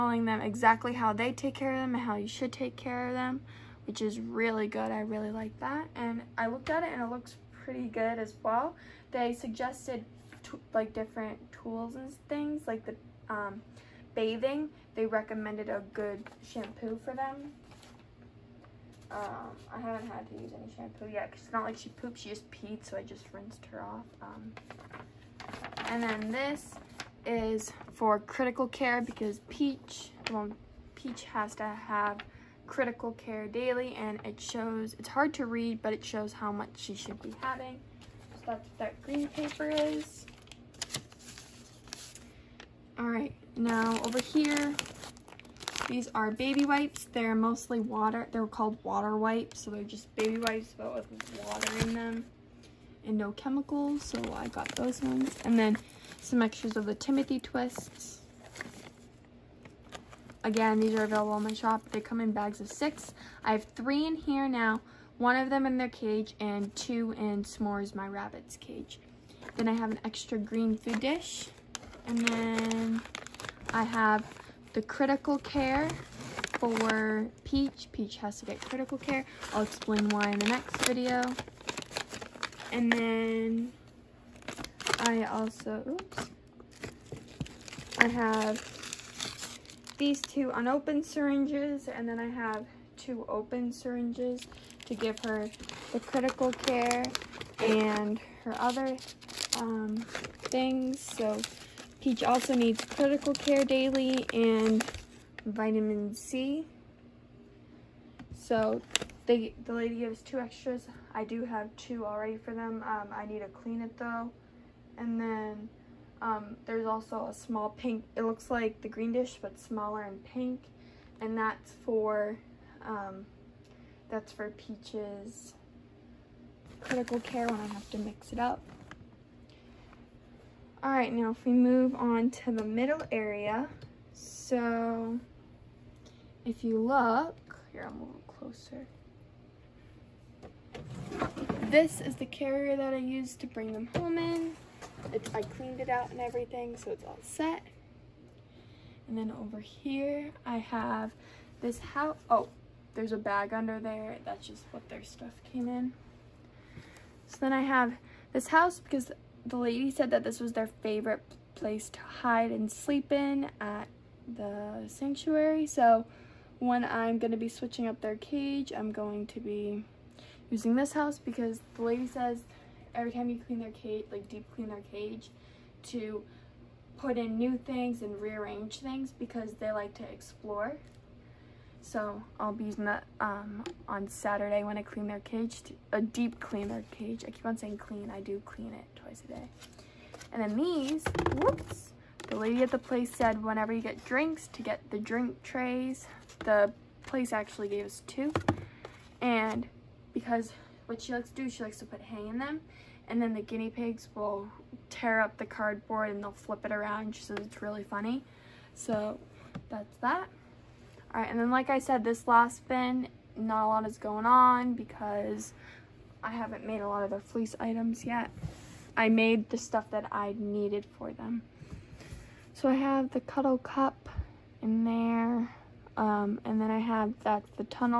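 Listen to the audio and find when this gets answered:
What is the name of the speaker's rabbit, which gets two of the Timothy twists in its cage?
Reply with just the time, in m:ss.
1:07.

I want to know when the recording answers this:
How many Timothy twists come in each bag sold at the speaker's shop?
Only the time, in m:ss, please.
1:02.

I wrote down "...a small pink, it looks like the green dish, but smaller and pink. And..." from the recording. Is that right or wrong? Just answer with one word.
right.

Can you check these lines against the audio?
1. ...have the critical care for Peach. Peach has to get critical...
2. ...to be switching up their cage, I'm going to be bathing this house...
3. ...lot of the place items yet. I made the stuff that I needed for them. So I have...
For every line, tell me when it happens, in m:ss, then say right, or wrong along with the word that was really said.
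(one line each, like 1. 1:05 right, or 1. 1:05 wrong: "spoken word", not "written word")
1. 1:13 right
2. 2:47 wrong: "using", not "bathing"
3. 3:36 wrong: "fleece", not "place".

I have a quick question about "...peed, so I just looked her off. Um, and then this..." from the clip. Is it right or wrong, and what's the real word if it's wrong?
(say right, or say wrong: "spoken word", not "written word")
wrong: "rinsed", not "looked".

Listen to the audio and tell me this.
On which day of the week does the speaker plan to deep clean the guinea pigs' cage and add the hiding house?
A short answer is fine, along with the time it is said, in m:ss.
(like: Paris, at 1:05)
Saturday, at 3:04.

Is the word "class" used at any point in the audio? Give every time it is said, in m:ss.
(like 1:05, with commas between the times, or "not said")
not said.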